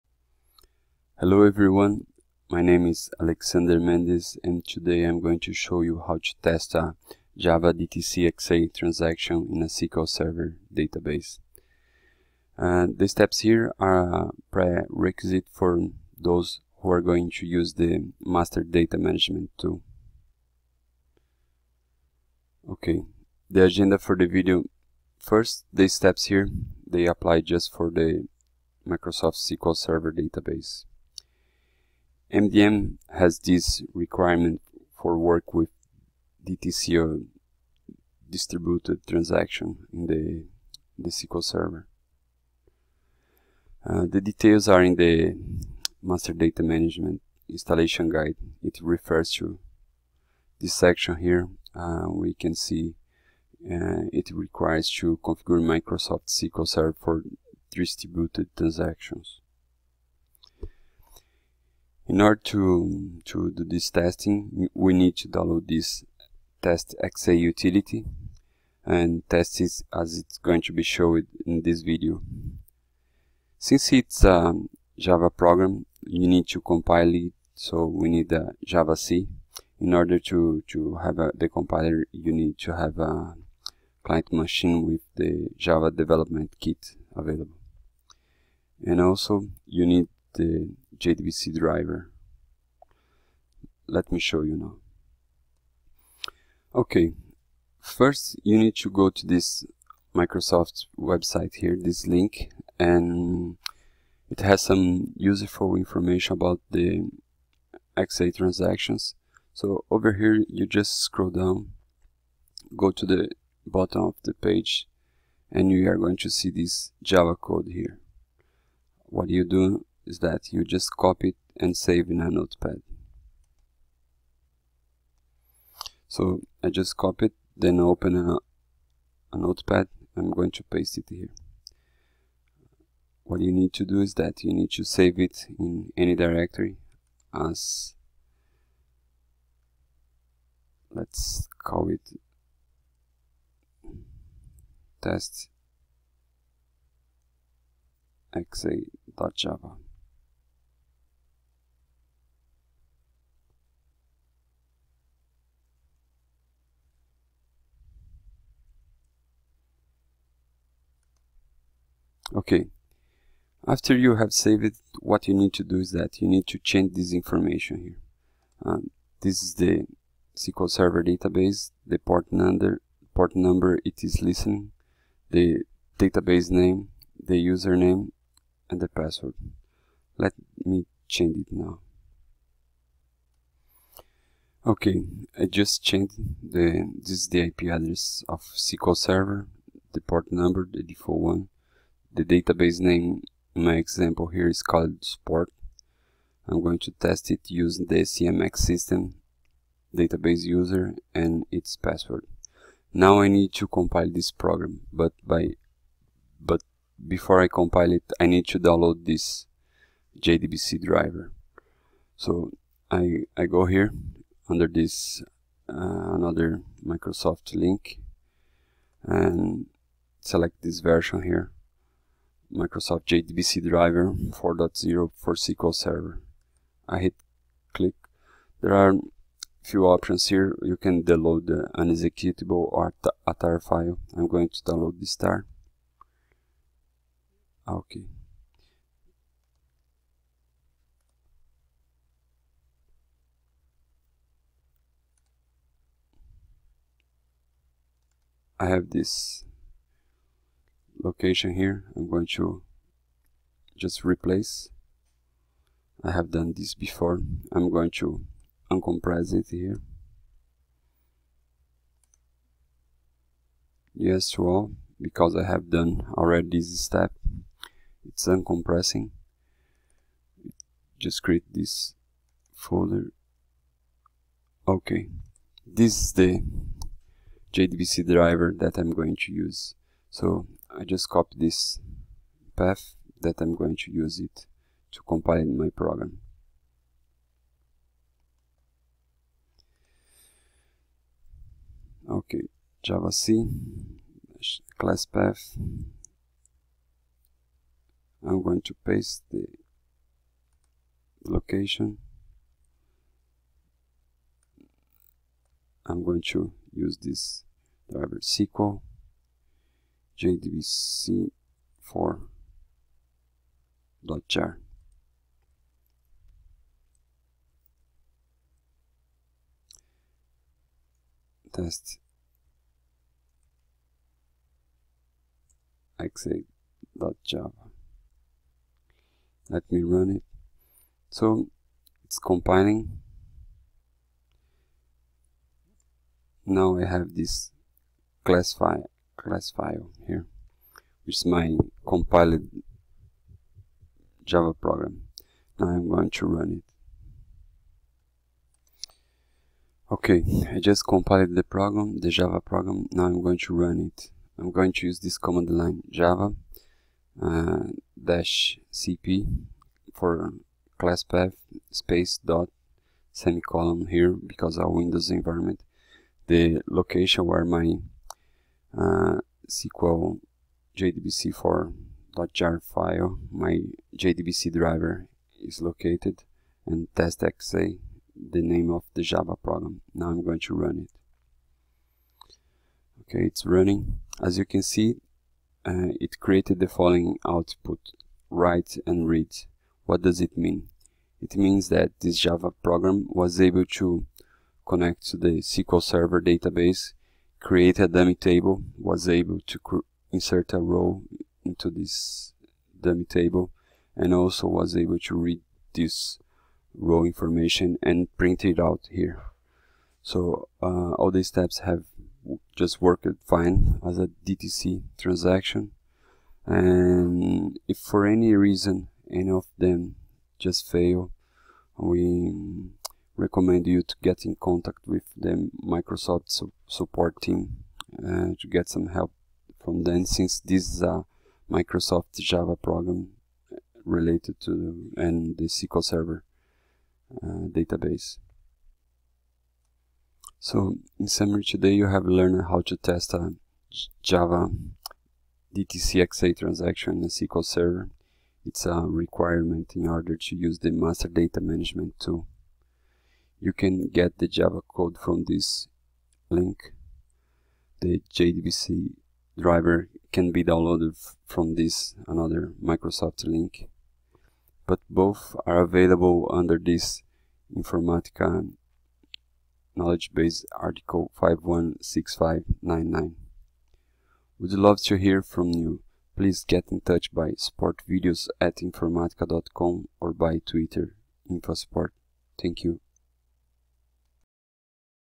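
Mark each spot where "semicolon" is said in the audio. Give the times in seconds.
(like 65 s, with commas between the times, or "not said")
363 s.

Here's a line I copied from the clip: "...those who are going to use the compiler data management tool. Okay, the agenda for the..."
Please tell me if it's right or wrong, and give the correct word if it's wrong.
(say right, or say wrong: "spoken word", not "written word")
wrong: "master", not "compiler".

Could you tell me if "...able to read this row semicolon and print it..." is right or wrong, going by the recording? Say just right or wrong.
wrong.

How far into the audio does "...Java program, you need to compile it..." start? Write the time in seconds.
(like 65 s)
74 s.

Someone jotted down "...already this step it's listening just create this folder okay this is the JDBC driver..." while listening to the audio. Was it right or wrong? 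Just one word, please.
wrong.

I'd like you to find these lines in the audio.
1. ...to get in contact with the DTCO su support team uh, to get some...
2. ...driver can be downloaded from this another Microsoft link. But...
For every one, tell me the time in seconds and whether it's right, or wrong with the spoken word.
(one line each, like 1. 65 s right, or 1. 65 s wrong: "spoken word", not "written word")
1. 423 s wrong: "Microsoft", not "DTCO"
2. 459 s right.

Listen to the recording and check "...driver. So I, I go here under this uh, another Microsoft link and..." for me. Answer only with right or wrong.
right.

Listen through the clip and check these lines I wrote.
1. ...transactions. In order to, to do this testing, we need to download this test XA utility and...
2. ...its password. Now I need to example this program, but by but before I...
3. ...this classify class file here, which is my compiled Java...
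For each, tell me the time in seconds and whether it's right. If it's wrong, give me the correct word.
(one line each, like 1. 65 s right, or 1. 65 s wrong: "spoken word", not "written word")
1. 58 s right
2. 201 s wrong: "compile", not "example"
3. 337 s right.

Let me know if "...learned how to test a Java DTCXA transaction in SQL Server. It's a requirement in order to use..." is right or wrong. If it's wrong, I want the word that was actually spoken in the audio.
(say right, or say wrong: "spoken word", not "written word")
right.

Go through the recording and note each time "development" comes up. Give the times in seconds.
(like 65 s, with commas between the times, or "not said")
85 s.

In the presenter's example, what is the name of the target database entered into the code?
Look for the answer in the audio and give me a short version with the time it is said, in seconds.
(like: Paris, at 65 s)
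Sport, at 195 s.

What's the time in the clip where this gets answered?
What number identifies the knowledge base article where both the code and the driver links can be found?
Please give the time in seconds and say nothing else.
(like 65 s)
471 s.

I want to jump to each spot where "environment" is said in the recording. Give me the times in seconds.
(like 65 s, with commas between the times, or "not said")
365 s.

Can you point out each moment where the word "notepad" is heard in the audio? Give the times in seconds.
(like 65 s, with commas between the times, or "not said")
122 s, 129 s.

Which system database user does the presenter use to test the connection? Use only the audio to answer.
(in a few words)
CMX system.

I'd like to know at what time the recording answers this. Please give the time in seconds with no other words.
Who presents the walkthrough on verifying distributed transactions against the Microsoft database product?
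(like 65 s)
3 s.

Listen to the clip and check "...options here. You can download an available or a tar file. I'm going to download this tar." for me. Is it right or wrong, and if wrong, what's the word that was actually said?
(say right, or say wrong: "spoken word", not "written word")
wrong: "executable", not "available".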